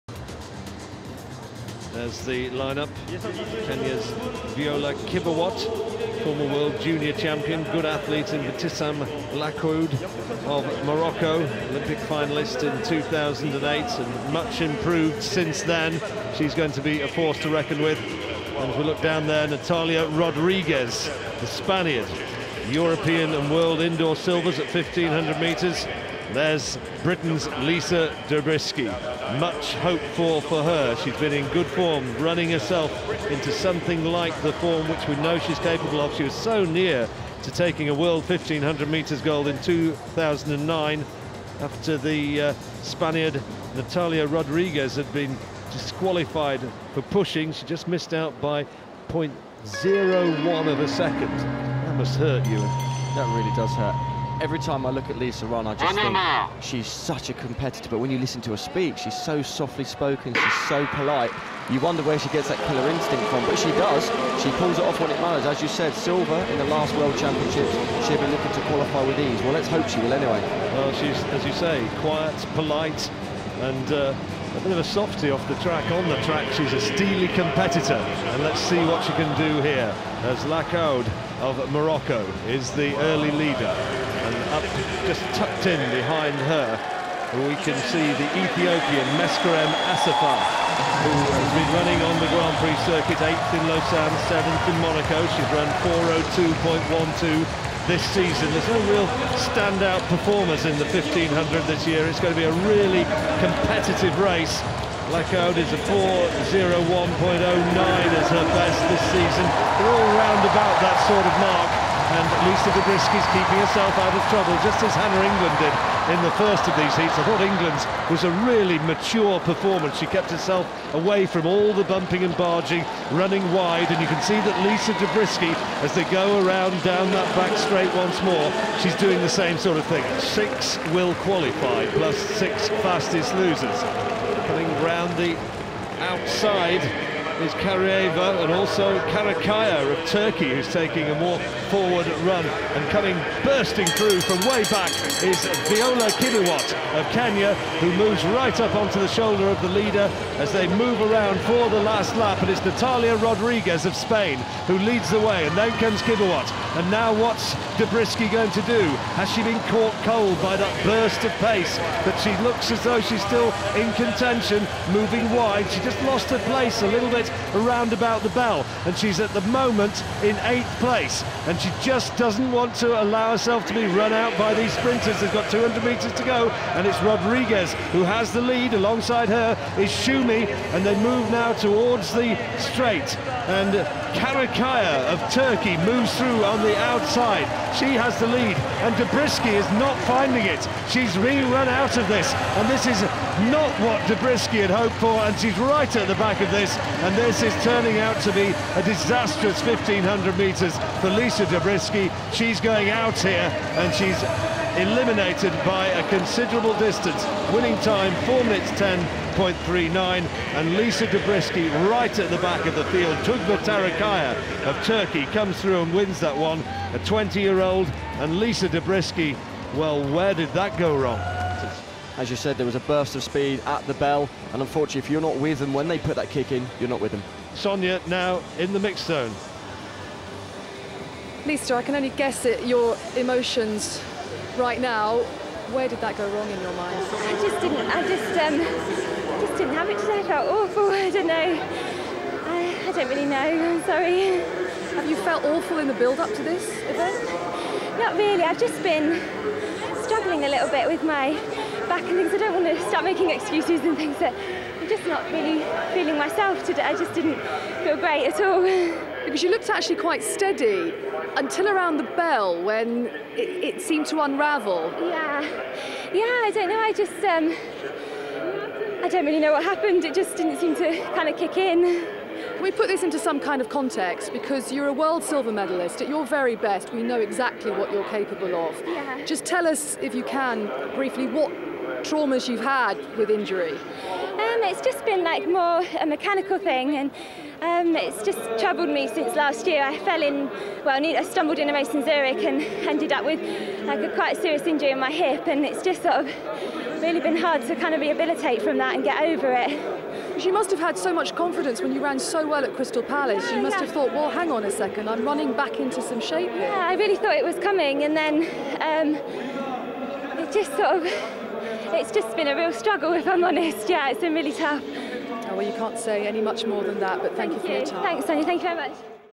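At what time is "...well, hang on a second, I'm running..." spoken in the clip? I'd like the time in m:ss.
5:04.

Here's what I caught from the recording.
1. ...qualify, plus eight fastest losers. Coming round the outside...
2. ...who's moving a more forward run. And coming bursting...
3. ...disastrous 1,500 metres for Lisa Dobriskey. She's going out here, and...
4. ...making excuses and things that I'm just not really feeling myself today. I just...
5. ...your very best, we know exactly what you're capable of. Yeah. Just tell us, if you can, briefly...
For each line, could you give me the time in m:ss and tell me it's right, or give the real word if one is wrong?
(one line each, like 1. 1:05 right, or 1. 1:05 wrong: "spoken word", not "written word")
1. 2:11 wrong: "six", not "eight"
2. 2:20 wrong: "taking", not "moving"
3. 3:18 right
4. 4:13 right
5. 4:36 right.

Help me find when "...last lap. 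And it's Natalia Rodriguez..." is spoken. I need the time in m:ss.
2:31.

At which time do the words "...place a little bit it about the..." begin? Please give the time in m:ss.
2:46.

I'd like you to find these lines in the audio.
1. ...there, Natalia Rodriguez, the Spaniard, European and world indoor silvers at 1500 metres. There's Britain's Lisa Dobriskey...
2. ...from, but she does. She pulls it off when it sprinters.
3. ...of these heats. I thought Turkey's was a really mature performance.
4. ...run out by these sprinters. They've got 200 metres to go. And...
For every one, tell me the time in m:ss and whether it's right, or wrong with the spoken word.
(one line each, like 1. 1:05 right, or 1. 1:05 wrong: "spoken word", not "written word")
1. 0:19 right
2. 1:03 wrong: "matters", not "sprinters"
3. 1:56 wrong: "England", not "Turkey"
4. 2:53 right.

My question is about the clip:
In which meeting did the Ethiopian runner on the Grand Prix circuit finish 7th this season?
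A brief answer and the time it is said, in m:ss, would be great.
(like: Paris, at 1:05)
Monaco, at 1:34.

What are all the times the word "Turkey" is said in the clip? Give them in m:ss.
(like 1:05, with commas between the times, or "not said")
2:20, 3:05, 3:34.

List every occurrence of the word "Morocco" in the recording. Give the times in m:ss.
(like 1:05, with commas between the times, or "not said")
0:10, 1:21.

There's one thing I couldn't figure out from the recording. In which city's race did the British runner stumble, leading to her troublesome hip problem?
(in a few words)
Zurich.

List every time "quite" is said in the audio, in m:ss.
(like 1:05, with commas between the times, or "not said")
4:19, 4:54.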